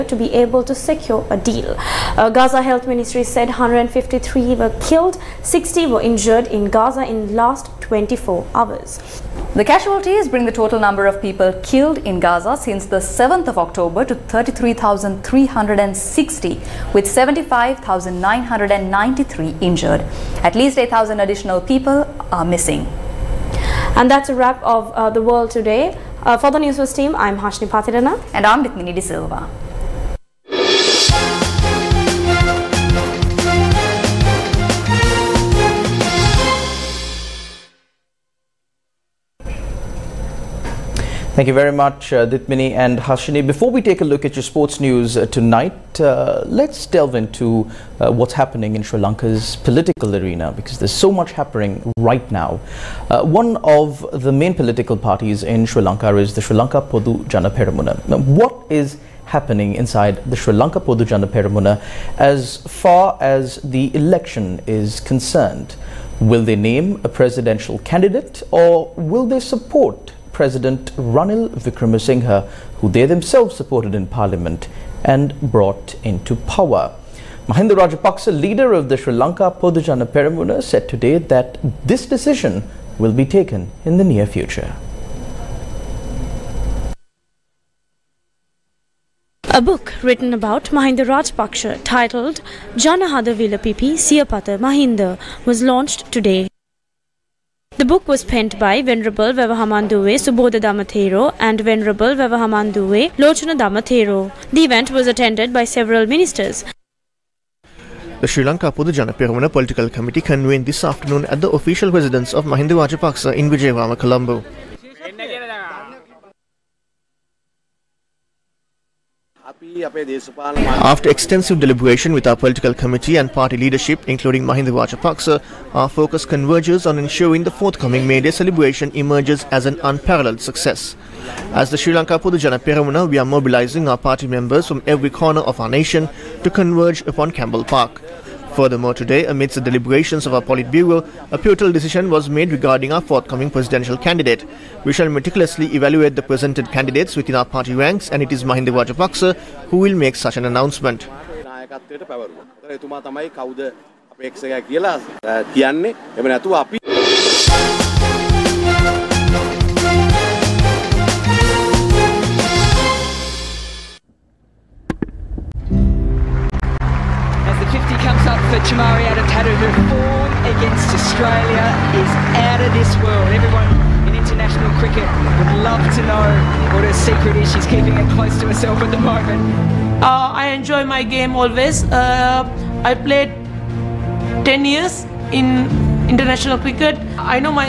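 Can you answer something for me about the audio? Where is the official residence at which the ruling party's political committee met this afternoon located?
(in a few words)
Vijayawada, Colombo.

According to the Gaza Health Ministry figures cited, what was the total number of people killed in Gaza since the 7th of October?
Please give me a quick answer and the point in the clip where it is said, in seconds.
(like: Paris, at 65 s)
33,360, at 14 s.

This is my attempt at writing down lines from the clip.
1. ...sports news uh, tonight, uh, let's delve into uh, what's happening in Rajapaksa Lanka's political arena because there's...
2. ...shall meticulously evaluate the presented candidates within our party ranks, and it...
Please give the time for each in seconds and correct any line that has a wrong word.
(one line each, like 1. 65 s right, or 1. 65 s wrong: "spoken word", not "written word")
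1. 44 s wrong: "Sri", not "Rajapaksa"
2. 144 s right.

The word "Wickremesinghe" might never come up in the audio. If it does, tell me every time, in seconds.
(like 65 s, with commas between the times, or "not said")
71 s.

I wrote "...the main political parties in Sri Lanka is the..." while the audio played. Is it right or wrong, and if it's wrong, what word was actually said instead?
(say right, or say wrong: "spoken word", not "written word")
right.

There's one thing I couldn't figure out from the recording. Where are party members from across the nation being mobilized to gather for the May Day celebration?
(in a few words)
Campbell Park.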